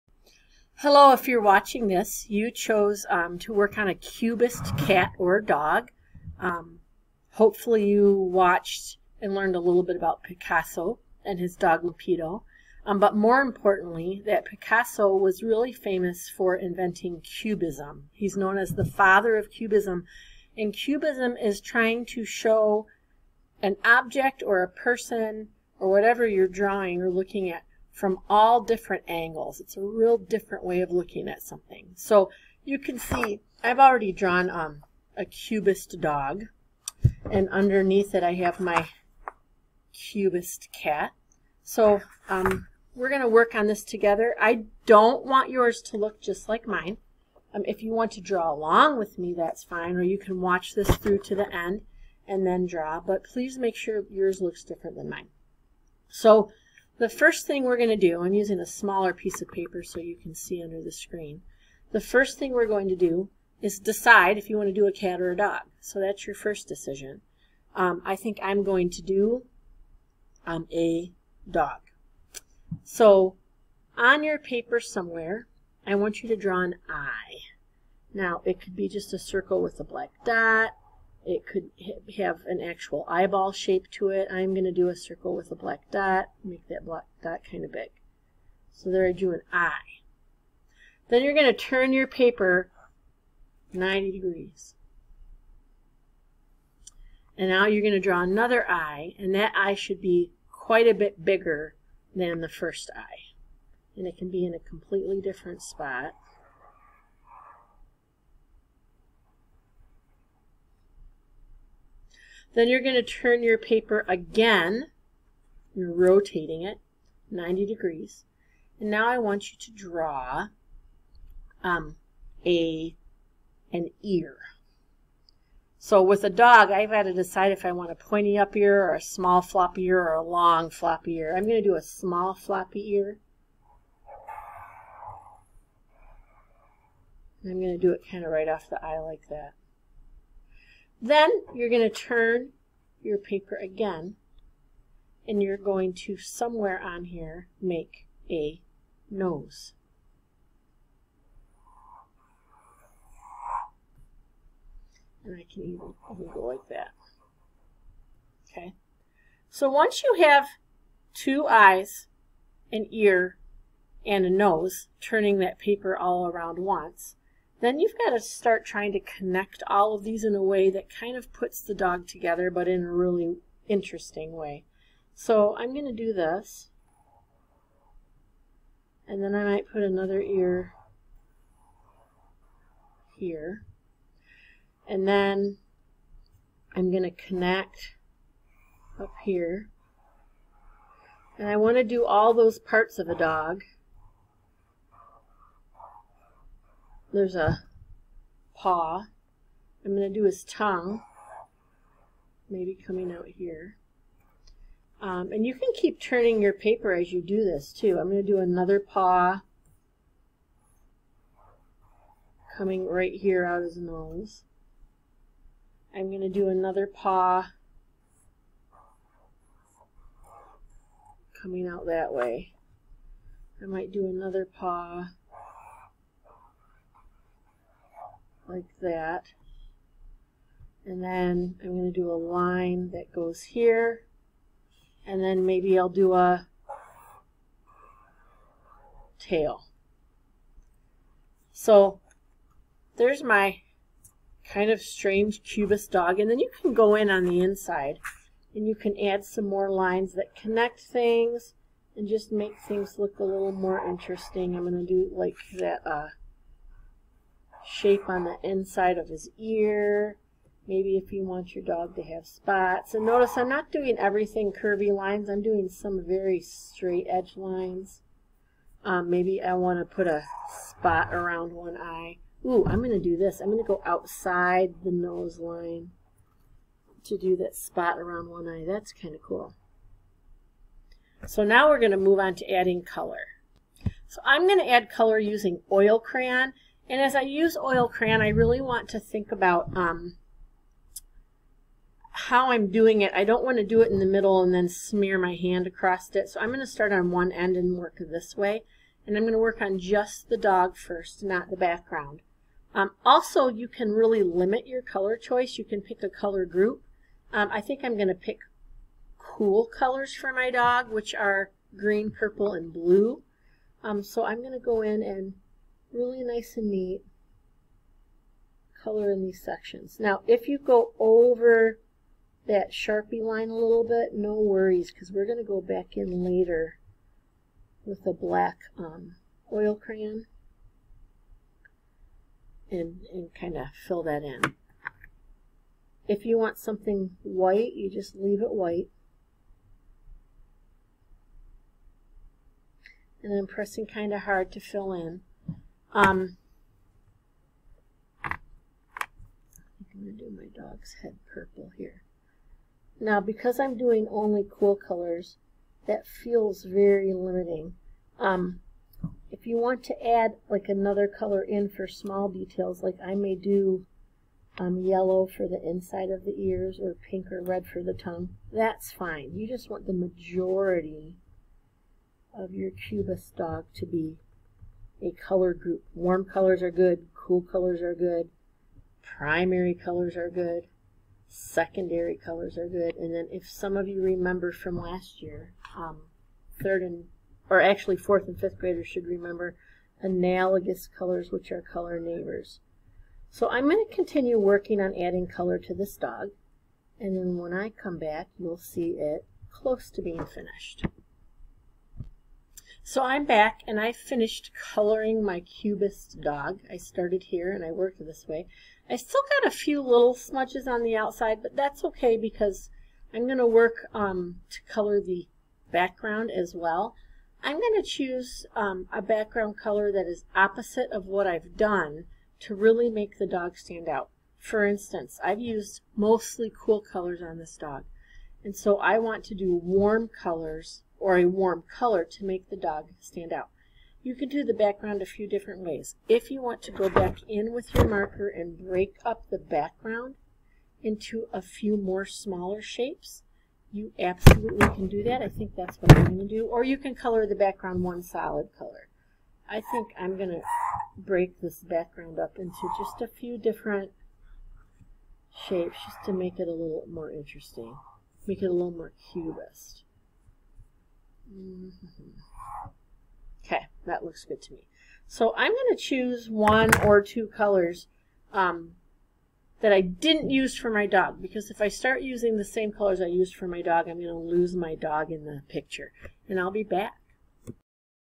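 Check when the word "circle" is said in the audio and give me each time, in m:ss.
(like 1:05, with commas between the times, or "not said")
1:19, 1:24.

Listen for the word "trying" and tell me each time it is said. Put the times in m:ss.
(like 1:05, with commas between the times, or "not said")
0:21, 2:48.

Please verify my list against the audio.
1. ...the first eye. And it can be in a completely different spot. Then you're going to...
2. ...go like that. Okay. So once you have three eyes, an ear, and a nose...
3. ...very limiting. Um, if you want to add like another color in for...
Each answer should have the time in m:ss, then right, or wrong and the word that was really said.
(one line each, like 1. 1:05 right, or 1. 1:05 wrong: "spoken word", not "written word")
1. 1:42 right
2. 2:36 wrong: "two", not "three"
3. 5:56 right.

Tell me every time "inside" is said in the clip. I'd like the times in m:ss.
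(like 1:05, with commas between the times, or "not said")
4:07, 4:18, 6:05.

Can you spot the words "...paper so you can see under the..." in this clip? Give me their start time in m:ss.
0:59.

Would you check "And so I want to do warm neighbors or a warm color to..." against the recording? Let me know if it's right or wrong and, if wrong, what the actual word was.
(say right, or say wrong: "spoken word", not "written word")
wrong: "colors", not "neighbors".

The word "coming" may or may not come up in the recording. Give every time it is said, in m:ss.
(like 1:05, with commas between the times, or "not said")
3:22, 3:32, 3:41.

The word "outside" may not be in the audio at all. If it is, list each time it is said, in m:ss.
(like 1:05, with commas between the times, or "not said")
4:33, 6:50.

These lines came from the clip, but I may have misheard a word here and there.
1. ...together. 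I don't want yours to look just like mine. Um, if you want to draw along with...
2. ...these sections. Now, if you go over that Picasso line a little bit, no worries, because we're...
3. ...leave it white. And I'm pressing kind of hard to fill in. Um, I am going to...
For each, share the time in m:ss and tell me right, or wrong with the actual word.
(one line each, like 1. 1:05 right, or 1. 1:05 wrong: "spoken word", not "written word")
1. 0:43 right
2. 5:19 wrong: "Sharpie", not "Picasso"
3. 5:38 right.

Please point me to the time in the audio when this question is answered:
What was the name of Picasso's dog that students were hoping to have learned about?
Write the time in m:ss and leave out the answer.
0:11.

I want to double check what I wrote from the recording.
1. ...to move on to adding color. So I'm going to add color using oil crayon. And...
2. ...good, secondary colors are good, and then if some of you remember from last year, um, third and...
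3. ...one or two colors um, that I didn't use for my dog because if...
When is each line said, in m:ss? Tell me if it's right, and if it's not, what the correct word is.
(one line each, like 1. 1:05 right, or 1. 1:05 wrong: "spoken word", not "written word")
1. 4:41 right
2. 6:20 right
3. 7:46 right.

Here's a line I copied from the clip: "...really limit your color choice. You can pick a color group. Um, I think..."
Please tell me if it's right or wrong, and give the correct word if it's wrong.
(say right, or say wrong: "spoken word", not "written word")
right.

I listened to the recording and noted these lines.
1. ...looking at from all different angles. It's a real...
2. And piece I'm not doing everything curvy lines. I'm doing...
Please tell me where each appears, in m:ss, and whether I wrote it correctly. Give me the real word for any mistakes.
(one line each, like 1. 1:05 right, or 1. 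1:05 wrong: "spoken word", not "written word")
1. 0:27 right
2. 4:22 wrong: "notice", not "piece".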